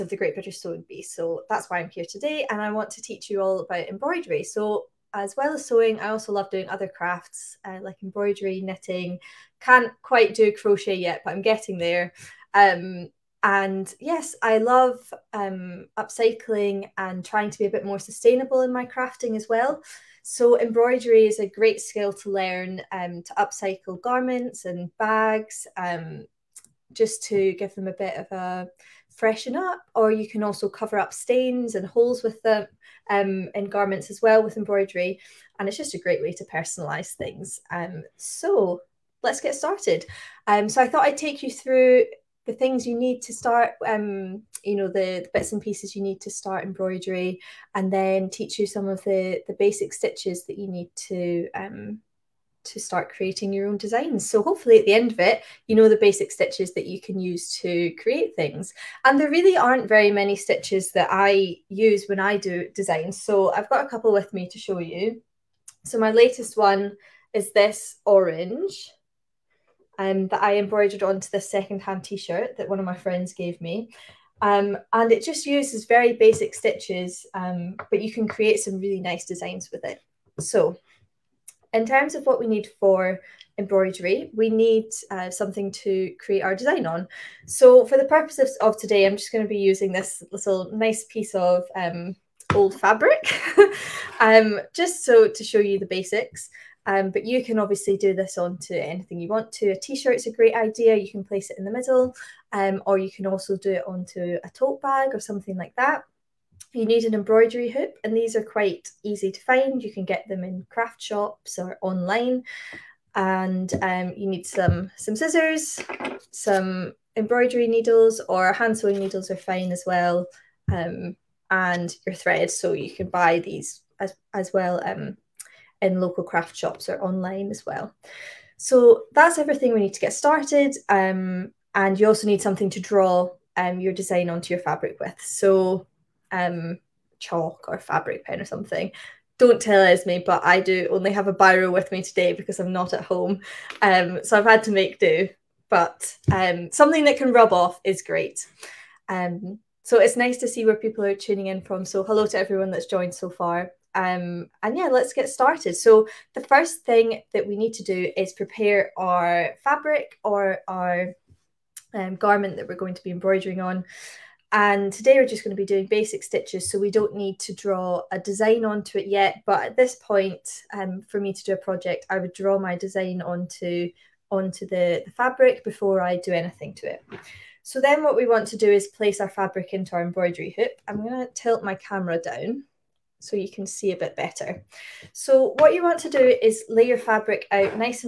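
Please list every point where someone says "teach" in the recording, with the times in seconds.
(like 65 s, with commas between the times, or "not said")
3 s, 48 s.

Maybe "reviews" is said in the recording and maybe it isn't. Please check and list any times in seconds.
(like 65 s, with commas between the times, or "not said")
not said.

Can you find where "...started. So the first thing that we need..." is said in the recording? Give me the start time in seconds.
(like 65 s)
155 s.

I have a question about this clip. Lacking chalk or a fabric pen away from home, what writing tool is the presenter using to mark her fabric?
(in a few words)
A biro.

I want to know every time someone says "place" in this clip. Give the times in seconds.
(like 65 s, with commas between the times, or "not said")
101 s, 178 s.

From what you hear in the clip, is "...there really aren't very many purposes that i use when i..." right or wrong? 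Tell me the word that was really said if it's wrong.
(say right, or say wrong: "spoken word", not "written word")
wrong: "stitches", not "purposes".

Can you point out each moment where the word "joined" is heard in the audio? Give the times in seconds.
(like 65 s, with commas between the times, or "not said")
152 s.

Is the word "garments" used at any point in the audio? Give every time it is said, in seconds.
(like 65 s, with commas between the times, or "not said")
24 s, 33 s, 162 s.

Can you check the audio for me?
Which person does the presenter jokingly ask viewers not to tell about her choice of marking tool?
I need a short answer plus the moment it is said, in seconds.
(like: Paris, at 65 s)
Esme, at 139 s.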